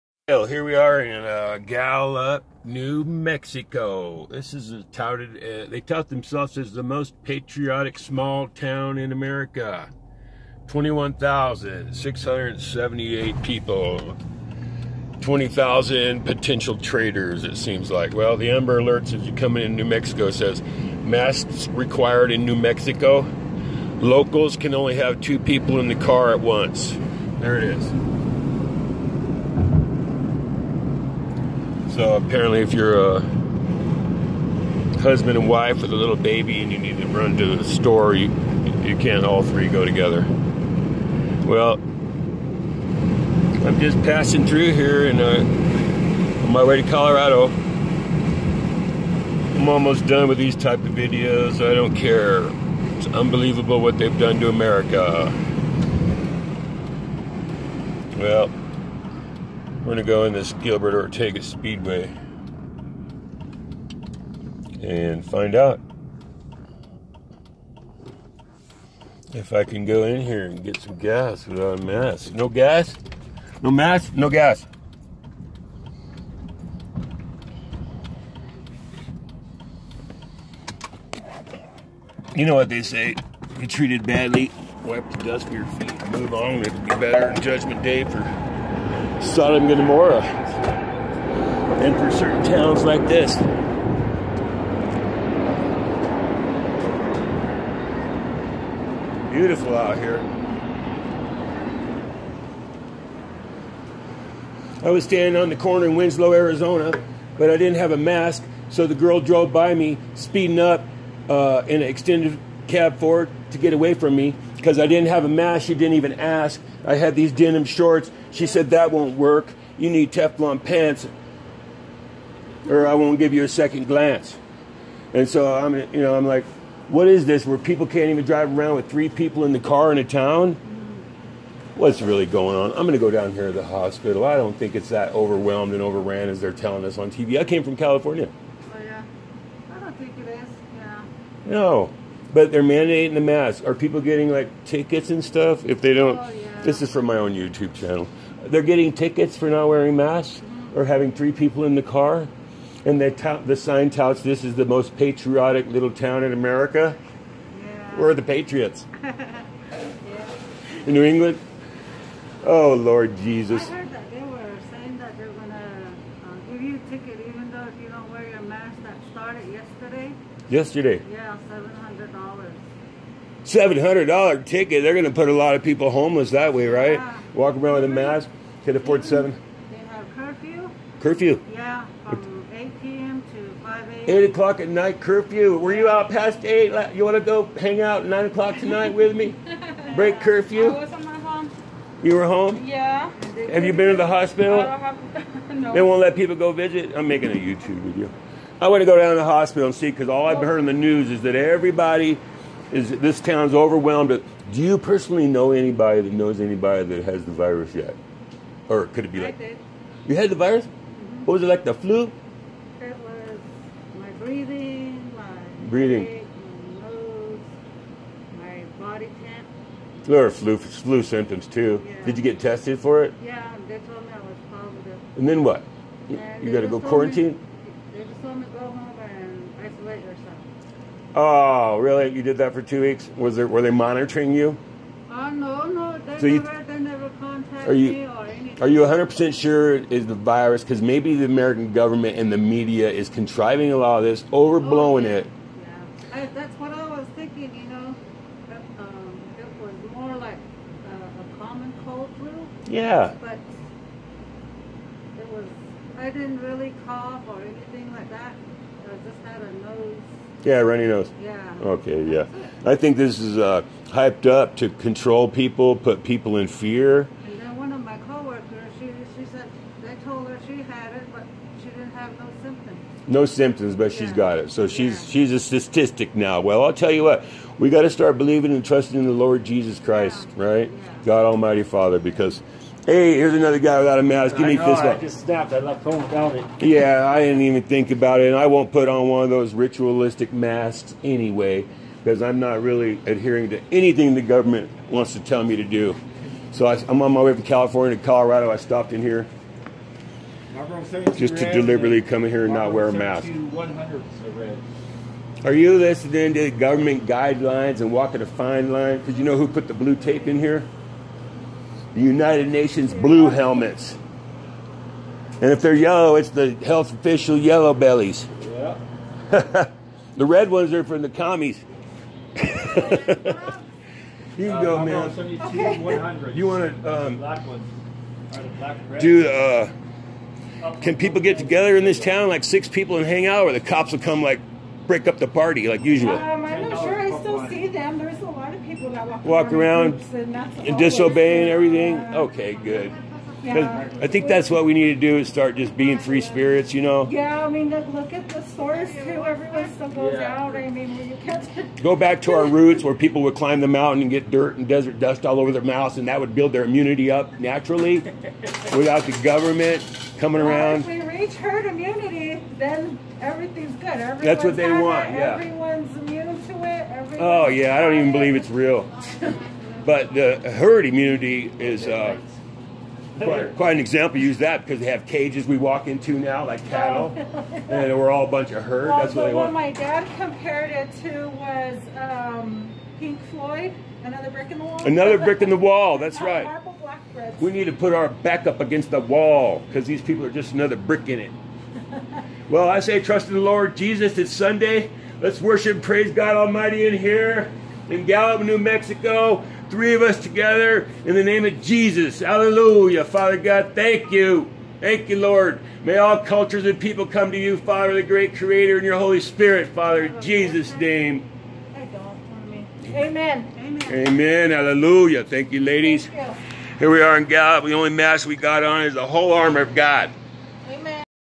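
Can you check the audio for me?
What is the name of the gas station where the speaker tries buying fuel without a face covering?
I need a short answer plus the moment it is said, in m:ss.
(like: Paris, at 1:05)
Gilbert Ortega Speedway, at 1:00.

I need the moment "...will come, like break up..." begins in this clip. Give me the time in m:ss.
5:33.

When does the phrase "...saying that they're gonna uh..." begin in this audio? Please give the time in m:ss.
2:44.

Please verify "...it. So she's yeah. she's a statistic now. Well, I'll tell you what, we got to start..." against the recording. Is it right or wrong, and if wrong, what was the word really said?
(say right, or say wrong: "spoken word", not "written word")
right.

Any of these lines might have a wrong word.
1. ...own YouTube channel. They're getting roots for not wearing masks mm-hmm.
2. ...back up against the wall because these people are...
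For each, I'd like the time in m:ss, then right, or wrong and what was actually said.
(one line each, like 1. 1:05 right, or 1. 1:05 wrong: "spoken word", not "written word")
1. 2:27 wrong: "tickets", not "roots"
2. 6:28 right.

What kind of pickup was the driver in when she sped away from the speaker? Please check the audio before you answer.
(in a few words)
Extended cab Ford.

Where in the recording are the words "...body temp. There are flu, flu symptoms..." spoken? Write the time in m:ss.
3:38.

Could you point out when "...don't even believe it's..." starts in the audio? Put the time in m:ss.
6:07.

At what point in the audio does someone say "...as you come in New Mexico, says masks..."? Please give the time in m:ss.
0:19.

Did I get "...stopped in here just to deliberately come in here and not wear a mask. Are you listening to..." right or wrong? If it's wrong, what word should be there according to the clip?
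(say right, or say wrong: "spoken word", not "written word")
right.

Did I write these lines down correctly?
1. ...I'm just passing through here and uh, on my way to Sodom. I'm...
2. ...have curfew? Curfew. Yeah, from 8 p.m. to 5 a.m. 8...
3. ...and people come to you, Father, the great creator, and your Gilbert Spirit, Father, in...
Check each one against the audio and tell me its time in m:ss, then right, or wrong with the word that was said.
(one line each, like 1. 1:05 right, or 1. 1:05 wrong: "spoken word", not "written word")
1. 0:41 wrong: "Colorado", not "Sodom"
2. 2:59 right
3. 6:46 wrong: "Holy", not "Gilbert".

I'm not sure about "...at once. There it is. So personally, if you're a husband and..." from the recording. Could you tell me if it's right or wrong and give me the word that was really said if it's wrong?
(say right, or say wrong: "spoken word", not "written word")
wrong: "apparently", not "personally".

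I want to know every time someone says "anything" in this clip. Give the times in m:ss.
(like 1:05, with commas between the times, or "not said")
3:58, 4:17, 4:53.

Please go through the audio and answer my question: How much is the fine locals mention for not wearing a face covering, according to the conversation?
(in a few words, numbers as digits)
$700.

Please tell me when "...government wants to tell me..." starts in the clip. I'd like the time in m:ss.
4:54.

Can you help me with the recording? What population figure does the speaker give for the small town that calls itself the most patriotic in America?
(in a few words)
21,678.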